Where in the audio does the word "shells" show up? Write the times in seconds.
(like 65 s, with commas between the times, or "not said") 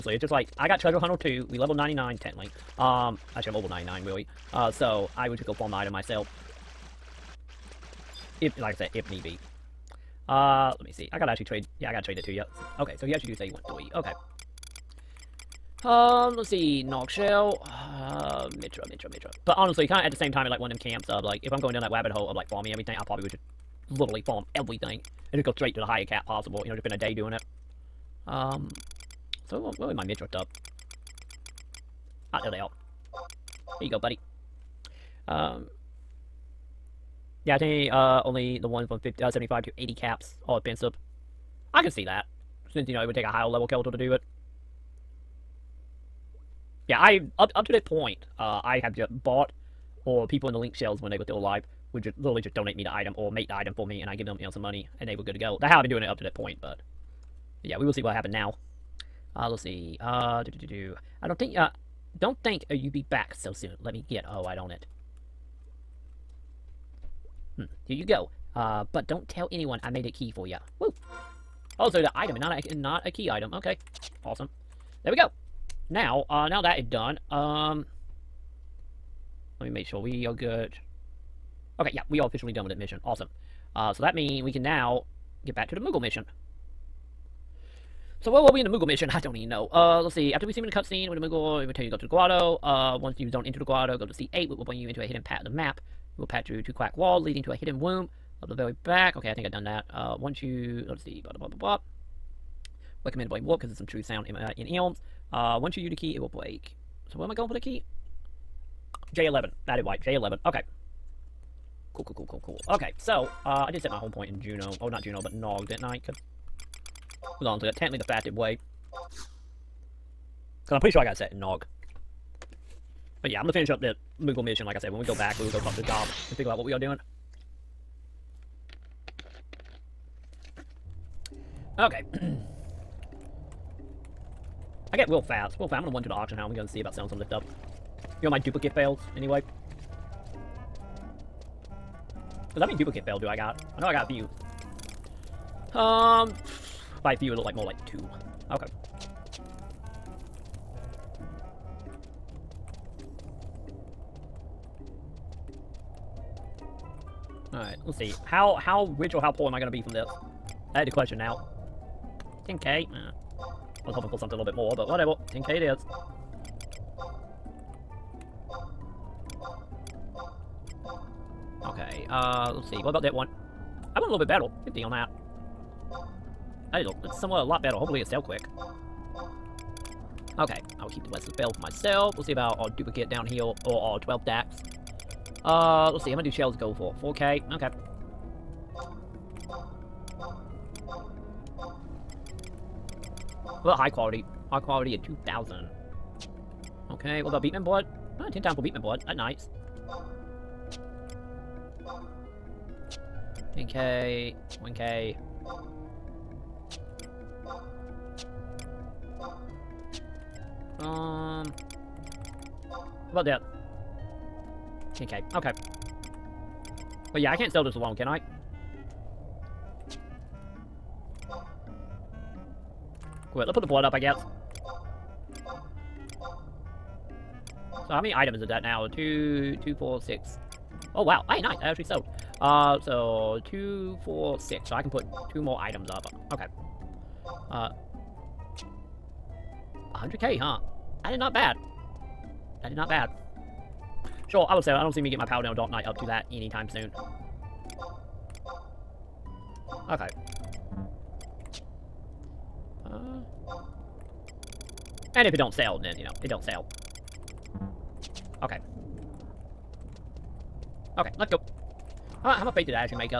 17 s, 50 s, 186 s.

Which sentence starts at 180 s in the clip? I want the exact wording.
Okay, I will keep the West Lapel for myself.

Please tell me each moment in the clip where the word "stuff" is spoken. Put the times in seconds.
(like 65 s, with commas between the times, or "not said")
30 s, 137 s.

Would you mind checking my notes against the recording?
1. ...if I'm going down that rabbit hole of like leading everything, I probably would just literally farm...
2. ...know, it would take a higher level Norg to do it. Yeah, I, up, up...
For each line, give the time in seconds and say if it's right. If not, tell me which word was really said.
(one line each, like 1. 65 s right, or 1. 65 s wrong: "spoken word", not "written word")
1. 21 s wrong: "farming", not "leading"
2. 42 s wrong: "Kelter", not "Norg".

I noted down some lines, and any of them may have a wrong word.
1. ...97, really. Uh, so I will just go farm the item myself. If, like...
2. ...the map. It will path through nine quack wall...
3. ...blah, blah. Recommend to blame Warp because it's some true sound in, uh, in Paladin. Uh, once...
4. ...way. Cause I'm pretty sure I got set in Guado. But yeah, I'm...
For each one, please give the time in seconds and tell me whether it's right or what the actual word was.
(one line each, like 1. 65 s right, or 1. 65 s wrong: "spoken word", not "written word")
1. 3 s wrong: "99", not "97"
2. 95 s wrong: "two", not "nine"
3. 101 s wrong: "Elms", not "Paladin"
4. 118 s wrong: "Norg", not "Guado".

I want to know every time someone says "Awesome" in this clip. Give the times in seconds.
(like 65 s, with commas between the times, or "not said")
74 s, 83 s.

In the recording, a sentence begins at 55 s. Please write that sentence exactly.
That's how I've been doing it up to that point, but, but yeah, we will see what happened now.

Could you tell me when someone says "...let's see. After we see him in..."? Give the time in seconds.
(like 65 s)
90 s.